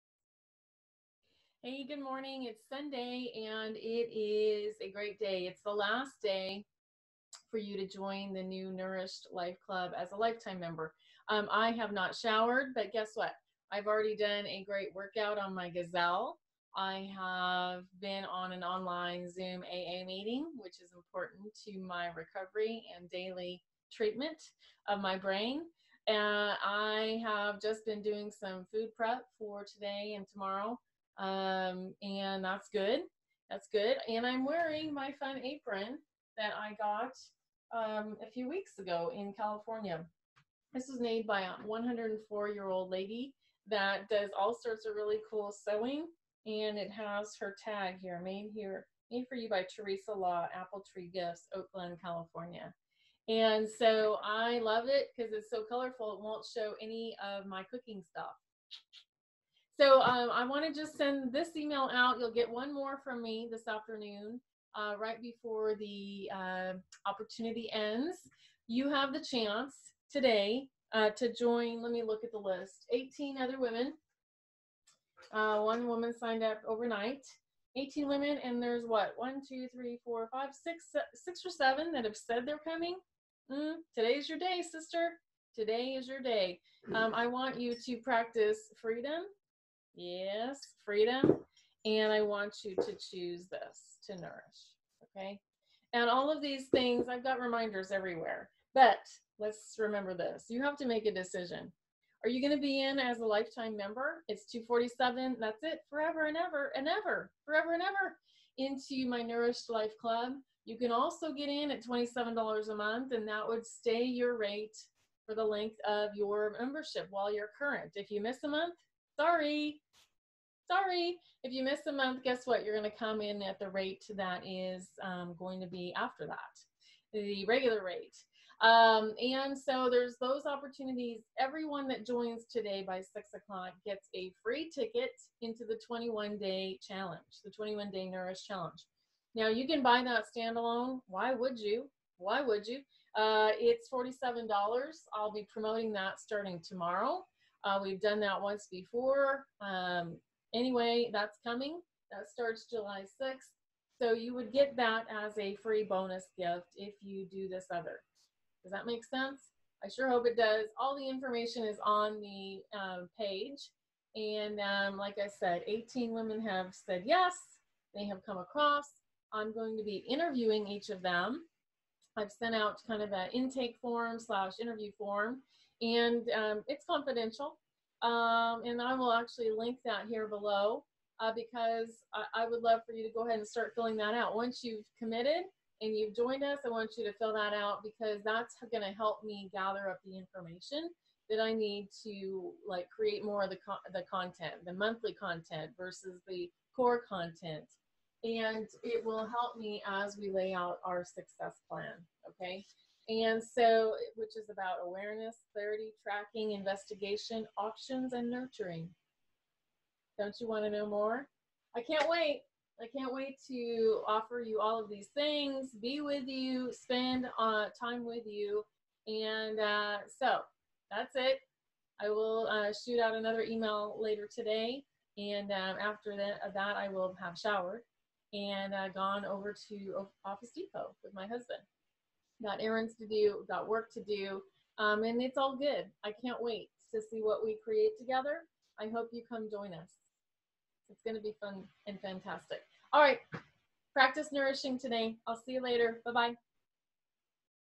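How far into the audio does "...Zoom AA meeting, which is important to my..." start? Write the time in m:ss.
0:19.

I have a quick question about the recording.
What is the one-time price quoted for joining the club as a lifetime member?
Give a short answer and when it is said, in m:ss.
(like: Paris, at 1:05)
$247, at 1:44.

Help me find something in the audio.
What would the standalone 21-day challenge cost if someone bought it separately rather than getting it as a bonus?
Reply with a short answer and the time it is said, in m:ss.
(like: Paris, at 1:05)
$47, at 2:23.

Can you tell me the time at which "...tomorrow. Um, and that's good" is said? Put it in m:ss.
0:30.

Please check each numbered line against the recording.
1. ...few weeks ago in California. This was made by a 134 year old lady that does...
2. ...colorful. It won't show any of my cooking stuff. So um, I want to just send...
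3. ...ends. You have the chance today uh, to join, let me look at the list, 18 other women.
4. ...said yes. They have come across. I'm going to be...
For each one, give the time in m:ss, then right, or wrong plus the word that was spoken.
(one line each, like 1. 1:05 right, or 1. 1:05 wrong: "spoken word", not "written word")
1. 0:38 wrong: "104", not "134"
2. 0:55 right
3. 1:07 right
4. 2:46 right.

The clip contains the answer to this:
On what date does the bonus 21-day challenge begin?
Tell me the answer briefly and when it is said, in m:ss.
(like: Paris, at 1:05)
July 6th, at 2:32.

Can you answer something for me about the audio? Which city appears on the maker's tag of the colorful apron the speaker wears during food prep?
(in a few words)
Oakland.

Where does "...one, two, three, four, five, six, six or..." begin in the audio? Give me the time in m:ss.
1:19.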